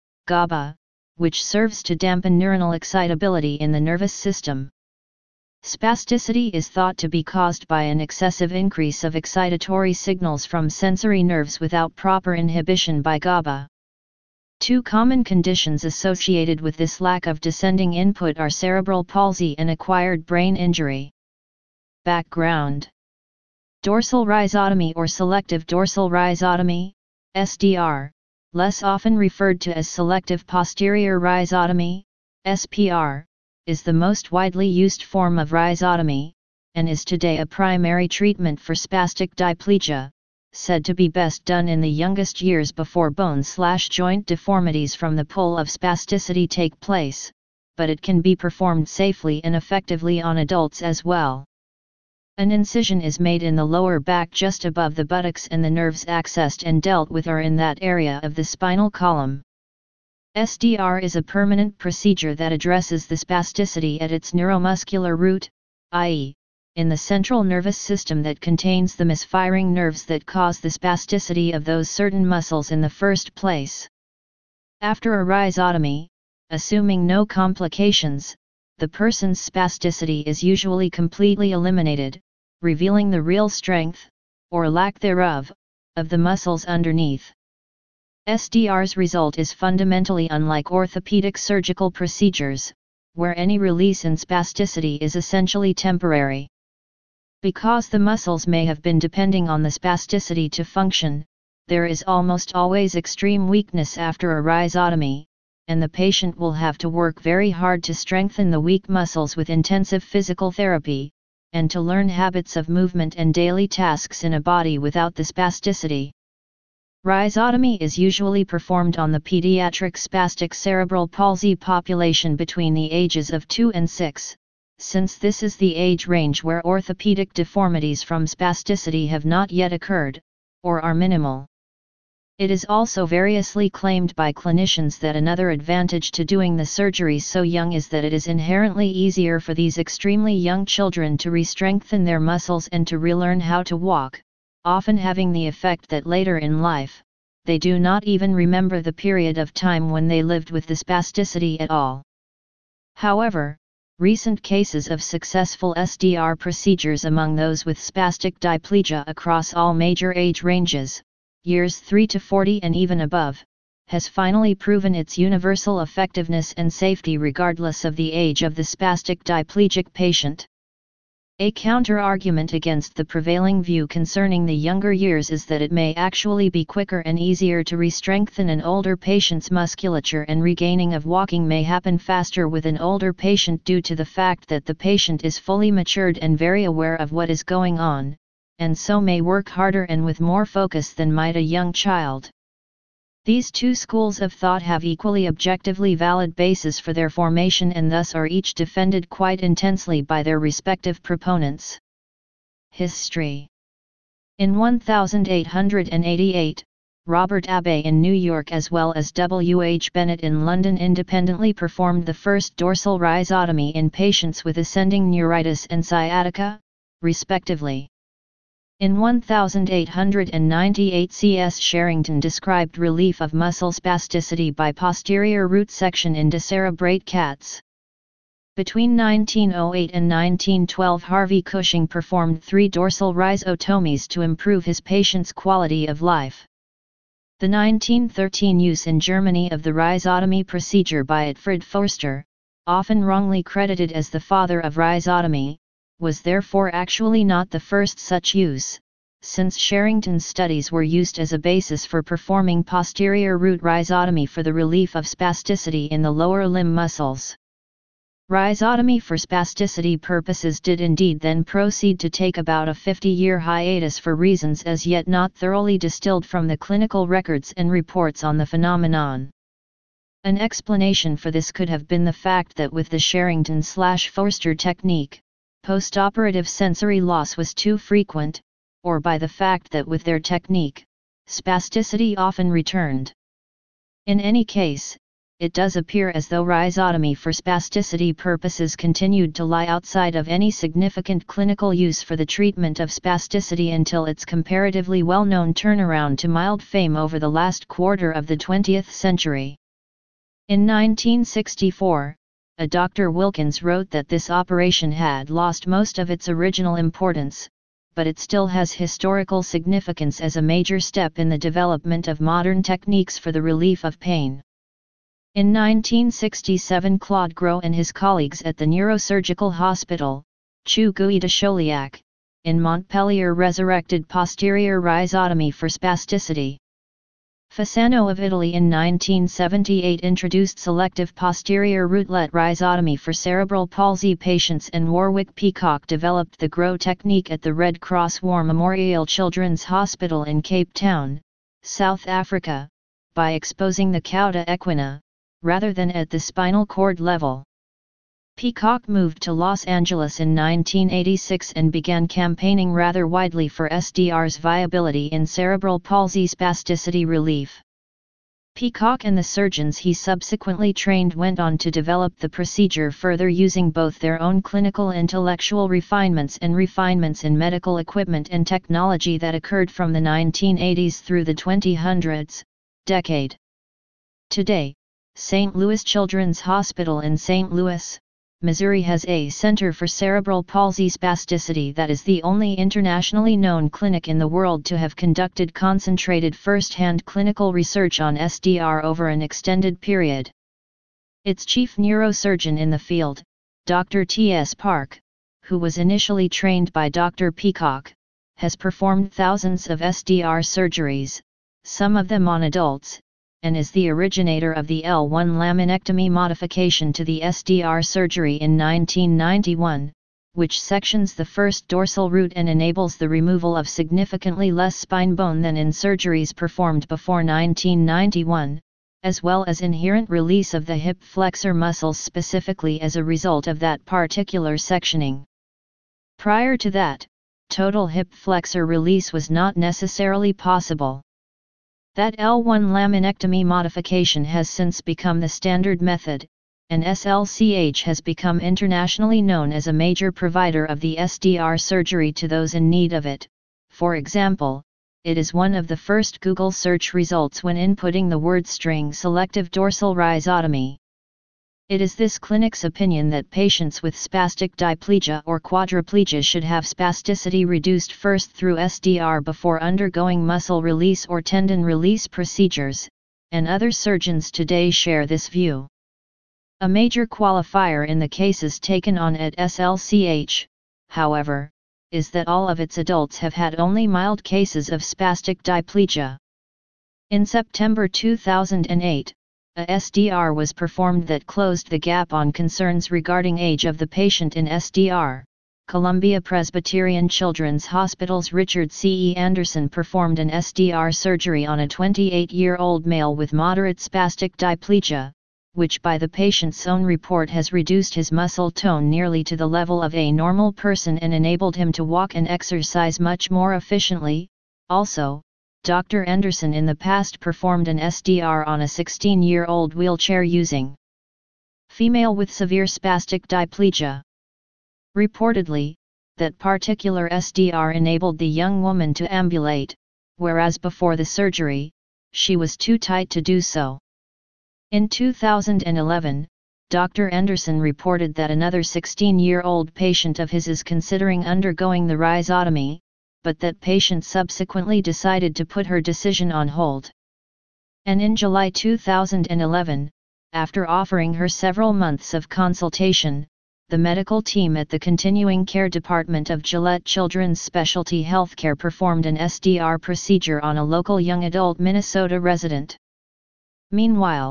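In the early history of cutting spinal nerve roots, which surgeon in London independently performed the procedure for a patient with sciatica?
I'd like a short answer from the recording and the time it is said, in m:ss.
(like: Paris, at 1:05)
W. H. Bennett, at 3:29.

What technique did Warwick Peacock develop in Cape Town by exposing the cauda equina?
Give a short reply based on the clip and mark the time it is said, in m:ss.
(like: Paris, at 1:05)
GROW technique, at 5:36.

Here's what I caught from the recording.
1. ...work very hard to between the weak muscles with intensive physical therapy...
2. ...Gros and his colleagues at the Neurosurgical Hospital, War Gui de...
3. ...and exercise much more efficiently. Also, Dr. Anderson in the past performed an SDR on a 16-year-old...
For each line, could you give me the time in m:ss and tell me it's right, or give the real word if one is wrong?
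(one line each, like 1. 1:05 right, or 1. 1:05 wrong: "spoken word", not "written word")
1. 1:46 wrong: "strengthen", not "between"
2. 5:17 wrong: "CHU", not "War"
3. 8:22 right.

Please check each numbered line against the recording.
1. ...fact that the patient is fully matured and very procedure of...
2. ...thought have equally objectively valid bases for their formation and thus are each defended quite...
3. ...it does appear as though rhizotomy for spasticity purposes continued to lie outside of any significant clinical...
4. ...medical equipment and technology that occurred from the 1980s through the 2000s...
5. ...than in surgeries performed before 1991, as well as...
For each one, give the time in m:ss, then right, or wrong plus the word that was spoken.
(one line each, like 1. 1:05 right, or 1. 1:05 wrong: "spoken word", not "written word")
1. 3:04 wrong: "aware", not "procedure"
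2. 3:14 right
3. 4:45 right
4. 6:07 right
5. 6:55 right.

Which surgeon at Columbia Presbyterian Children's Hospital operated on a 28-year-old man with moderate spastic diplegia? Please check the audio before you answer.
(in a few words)
Richard C. E. Anderson.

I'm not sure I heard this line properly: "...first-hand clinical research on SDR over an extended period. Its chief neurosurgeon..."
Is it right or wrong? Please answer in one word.
right.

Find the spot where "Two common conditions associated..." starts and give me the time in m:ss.
0:14.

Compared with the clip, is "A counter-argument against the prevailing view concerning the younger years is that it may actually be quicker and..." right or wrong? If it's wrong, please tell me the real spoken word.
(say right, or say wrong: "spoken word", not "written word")
right.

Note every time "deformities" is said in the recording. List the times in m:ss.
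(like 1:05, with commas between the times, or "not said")
0:44, 2:07.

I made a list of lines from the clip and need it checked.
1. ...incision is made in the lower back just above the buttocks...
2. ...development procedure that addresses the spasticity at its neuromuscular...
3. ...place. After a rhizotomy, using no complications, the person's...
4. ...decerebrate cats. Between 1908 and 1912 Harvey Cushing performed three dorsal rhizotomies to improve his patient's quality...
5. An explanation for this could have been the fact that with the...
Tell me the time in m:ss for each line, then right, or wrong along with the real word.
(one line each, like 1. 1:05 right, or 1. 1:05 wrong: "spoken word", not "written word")
1. 0:52 right
2. 1:01 wrong: "permanent", not "development"
3. 1:13 wrong: "assuming", not "using"
4. 3:46 right
5. 4:30 right.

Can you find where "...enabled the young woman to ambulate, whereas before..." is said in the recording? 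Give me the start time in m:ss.
8:37.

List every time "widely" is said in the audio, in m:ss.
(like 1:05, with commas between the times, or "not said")
0:34, 5:53.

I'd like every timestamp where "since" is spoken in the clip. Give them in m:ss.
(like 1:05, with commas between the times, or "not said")
2:04, 4:09, 7:14.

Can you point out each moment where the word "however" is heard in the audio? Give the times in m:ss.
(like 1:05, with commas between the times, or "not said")
2:32, 7:50.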